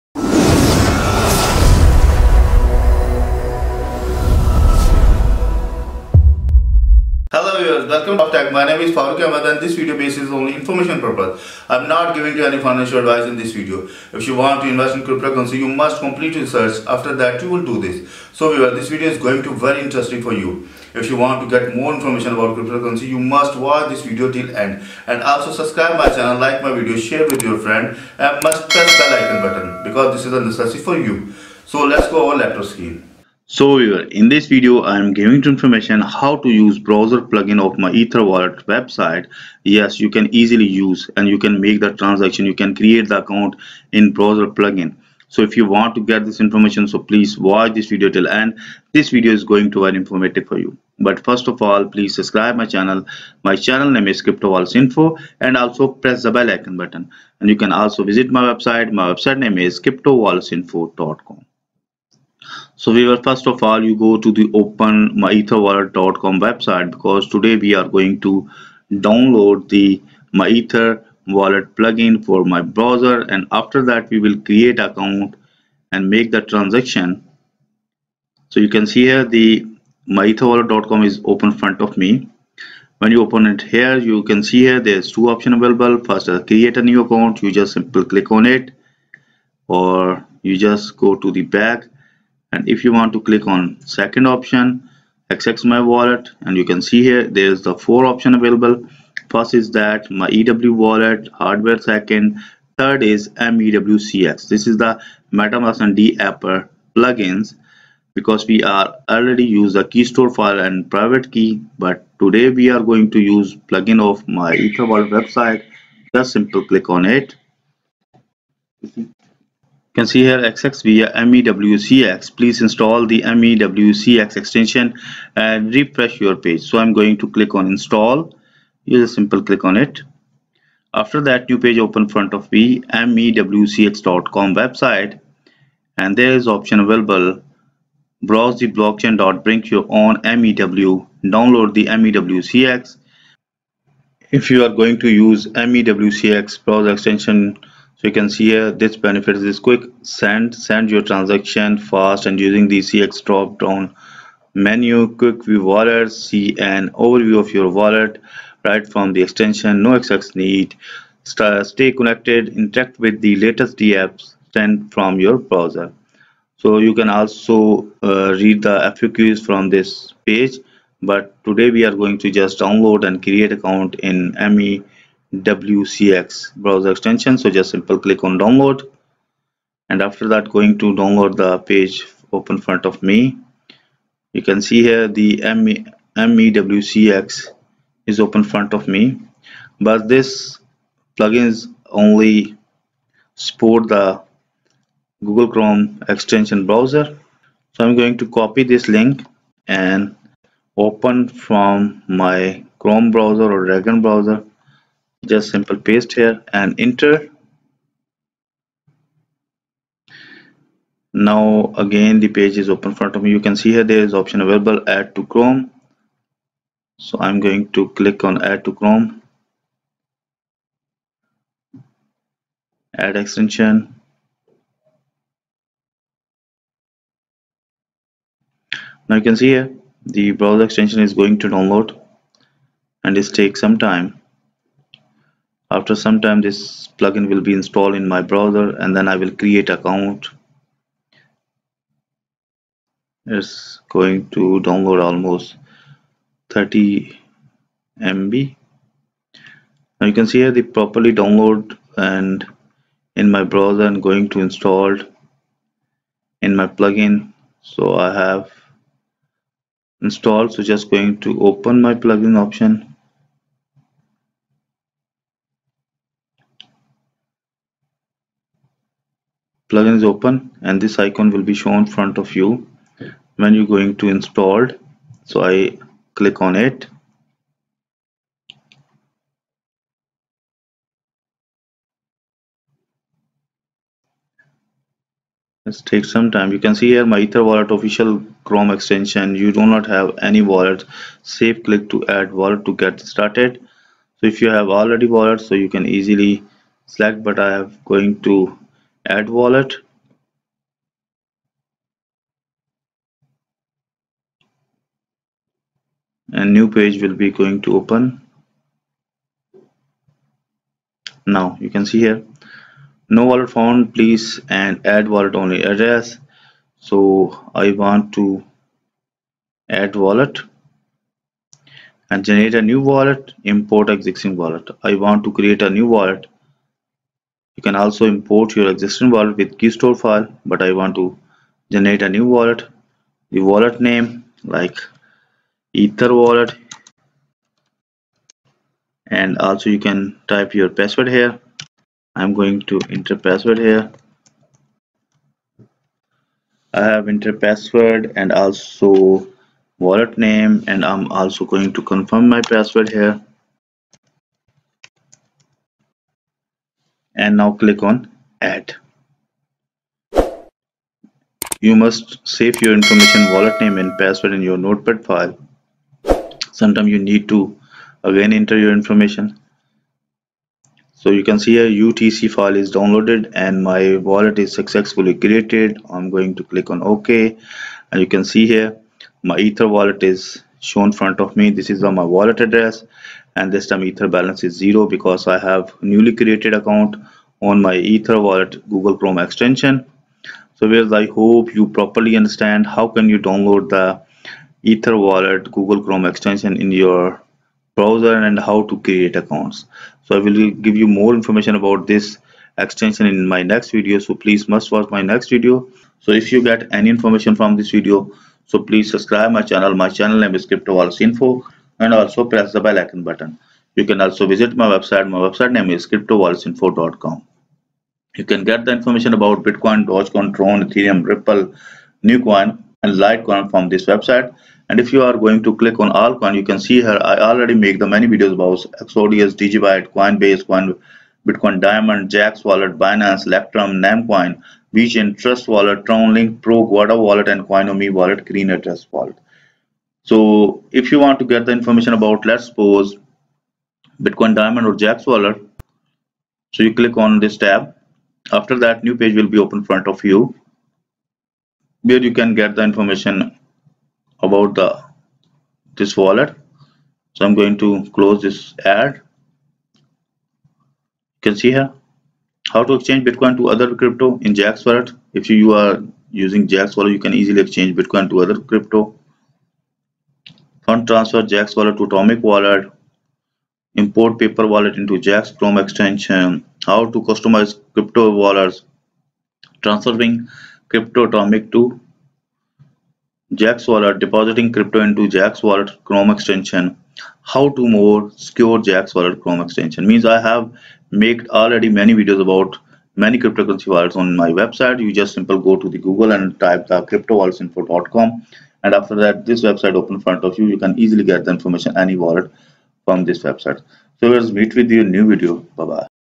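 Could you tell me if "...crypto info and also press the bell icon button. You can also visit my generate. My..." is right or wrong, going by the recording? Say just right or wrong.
wrong.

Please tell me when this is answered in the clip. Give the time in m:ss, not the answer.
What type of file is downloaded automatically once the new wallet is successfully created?
6:11.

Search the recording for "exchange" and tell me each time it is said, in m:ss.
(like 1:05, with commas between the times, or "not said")
7:42, 7:47.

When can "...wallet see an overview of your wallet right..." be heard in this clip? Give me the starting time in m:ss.
2:35.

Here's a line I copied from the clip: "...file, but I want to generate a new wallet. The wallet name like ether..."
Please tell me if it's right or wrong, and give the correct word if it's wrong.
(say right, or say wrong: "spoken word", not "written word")
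right.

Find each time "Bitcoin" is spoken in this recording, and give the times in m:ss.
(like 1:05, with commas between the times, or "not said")
6:59, 7:11, 7:24, 7:43, 7:47.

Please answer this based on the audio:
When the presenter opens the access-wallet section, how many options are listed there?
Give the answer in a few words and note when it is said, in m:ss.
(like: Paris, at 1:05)
4, at 1:37.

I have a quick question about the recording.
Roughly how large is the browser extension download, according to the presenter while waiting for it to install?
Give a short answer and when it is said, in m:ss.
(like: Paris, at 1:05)
30 MB, at 4:06.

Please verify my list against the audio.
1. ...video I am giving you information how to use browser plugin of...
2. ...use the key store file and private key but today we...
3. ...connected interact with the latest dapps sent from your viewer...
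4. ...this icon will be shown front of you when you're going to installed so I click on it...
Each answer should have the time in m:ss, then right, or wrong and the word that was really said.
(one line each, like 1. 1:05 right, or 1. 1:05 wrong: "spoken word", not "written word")
1. 0:34 right
2. 1:49 right
3. 2:41 wrong: "browser", not "viewer"
4. 4:30 right.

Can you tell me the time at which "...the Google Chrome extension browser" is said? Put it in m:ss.
3:13.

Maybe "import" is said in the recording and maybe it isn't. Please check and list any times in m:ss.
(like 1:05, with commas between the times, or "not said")
5:23, 5:28, 7:53.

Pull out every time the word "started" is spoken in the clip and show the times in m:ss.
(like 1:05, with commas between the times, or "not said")
4:53.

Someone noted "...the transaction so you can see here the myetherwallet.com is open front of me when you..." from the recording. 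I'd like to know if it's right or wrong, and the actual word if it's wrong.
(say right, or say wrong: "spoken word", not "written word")
right.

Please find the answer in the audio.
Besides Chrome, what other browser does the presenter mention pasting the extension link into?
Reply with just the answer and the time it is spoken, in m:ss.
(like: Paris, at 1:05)
Dragon, at 3:23.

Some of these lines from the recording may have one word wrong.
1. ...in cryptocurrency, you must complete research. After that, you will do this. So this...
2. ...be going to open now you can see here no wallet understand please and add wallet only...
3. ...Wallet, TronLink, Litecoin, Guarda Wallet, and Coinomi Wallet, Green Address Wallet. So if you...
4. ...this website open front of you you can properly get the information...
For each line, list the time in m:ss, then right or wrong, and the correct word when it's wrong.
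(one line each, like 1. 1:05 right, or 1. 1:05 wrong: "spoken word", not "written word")
1. 0:14 right
2. 5:07 wrong: "found", not "understand"
3. 7:15 wrong: "Pro", not "Litecoin"
4. 8:19 wrong: "easily", not "properly".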